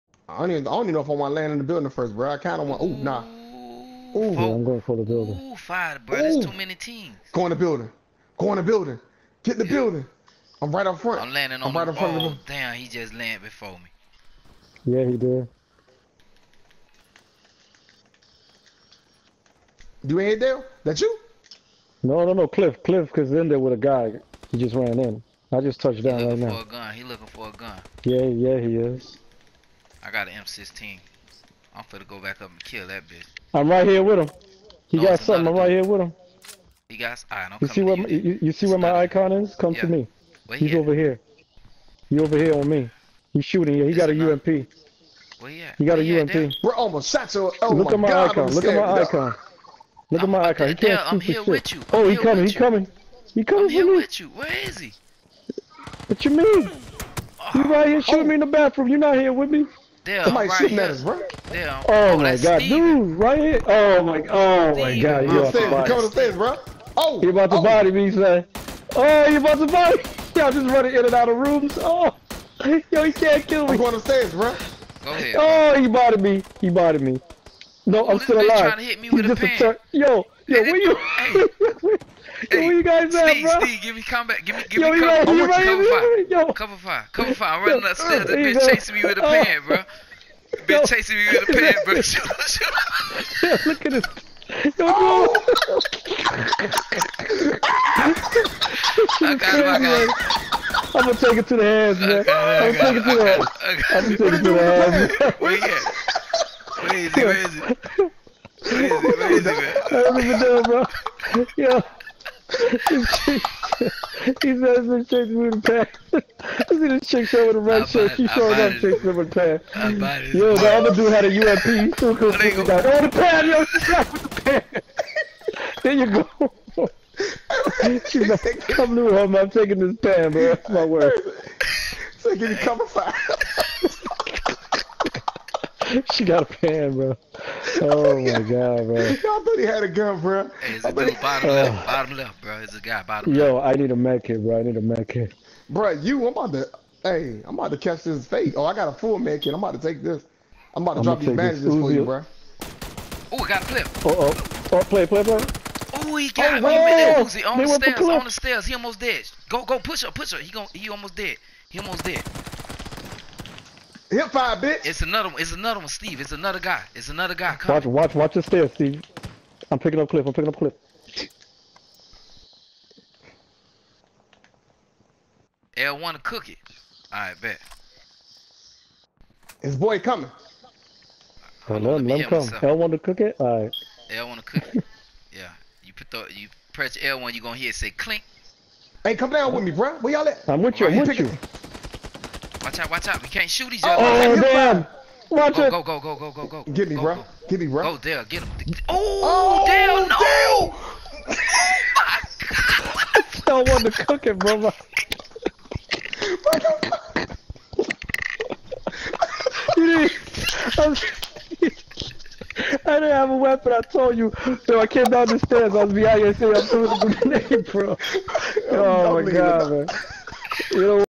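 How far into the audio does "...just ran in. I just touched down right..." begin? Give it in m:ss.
0:24.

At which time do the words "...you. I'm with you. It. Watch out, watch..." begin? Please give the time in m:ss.
3:10.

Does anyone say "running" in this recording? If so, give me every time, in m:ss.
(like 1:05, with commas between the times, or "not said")
1:10, 1:27.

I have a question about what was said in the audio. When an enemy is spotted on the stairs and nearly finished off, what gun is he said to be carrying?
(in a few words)
Uzi.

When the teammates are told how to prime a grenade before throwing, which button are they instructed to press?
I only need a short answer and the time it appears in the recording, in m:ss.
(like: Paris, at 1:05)
L1, at 2:55.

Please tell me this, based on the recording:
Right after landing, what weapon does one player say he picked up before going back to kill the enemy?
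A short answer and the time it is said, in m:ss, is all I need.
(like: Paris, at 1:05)
M16, at 0:30.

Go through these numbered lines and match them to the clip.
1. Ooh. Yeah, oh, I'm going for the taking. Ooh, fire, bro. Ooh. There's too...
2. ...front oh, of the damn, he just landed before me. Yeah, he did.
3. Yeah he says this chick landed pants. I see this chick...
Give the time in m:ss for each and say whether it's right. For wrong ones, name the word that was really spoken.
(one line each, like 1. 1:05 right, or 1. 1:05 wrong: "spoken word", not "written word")
1. 0:03 wrong: "building", not "taking"
2. 0:11 right
3. 1:51 wrong: "moved", not "landed".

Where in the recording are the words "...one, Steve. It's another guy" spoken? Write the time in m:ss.
2:45.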